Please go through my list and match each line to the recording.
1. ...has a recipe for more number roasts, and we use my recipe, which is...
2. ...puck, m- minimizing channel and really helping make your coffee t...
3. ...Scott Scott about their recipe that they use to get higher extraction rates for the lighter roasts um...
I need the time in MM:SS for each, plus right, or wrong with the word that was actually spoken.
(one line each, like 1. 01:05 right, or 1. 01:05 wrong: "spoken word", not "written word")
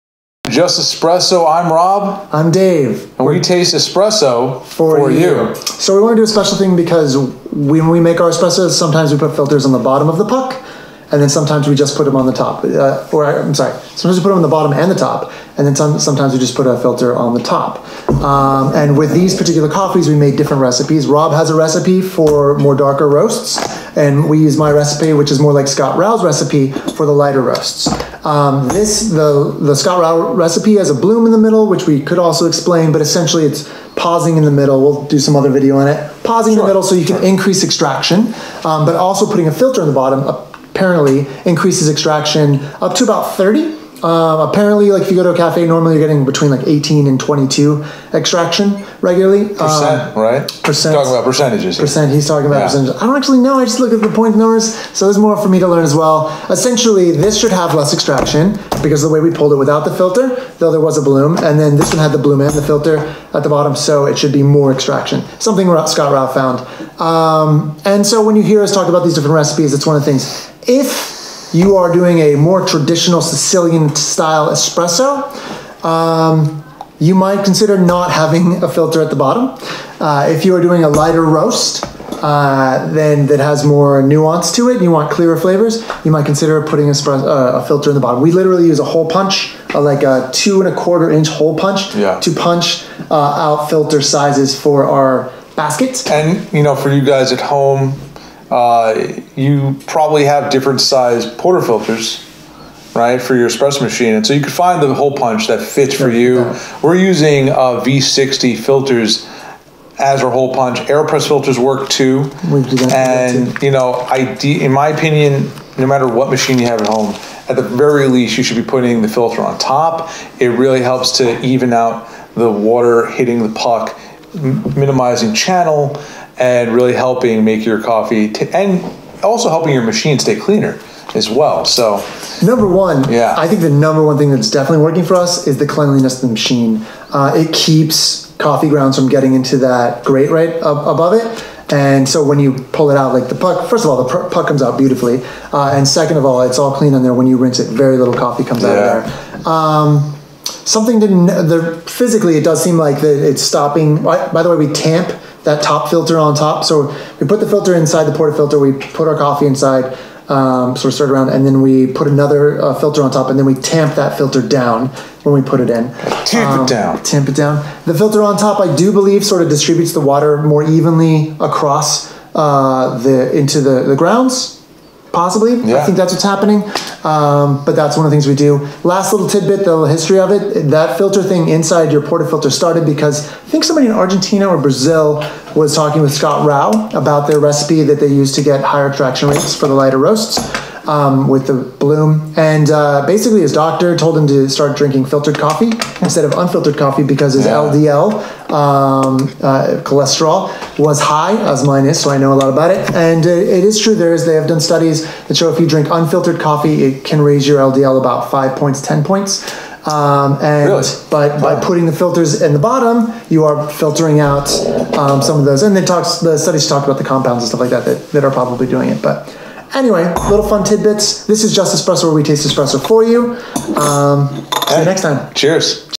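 1. 00:21 wrong: "darker", not "number"
2. 02:03 right
3. 03:06 wrong: "Rao", not "Scott".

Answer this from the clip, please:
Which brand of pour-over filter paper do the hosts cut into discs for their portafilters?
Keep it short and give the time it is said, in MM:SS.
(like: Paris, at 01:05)
V60, at 01:47.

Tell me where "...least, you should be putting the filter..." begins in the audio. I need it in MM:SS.
01:58.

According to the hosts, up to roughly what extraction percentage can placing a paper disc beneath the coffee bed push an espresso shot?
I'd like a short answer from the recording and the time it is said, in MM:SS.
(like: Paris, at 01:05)
30, at 00:43.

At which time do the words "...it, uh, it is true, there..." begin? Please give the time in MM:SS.
03:23.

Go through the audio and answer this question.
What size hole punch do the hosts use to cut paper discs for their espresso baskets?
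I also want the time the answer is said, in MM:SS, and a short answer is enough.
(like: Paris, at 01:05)
2 1/4 inch, at 01:30.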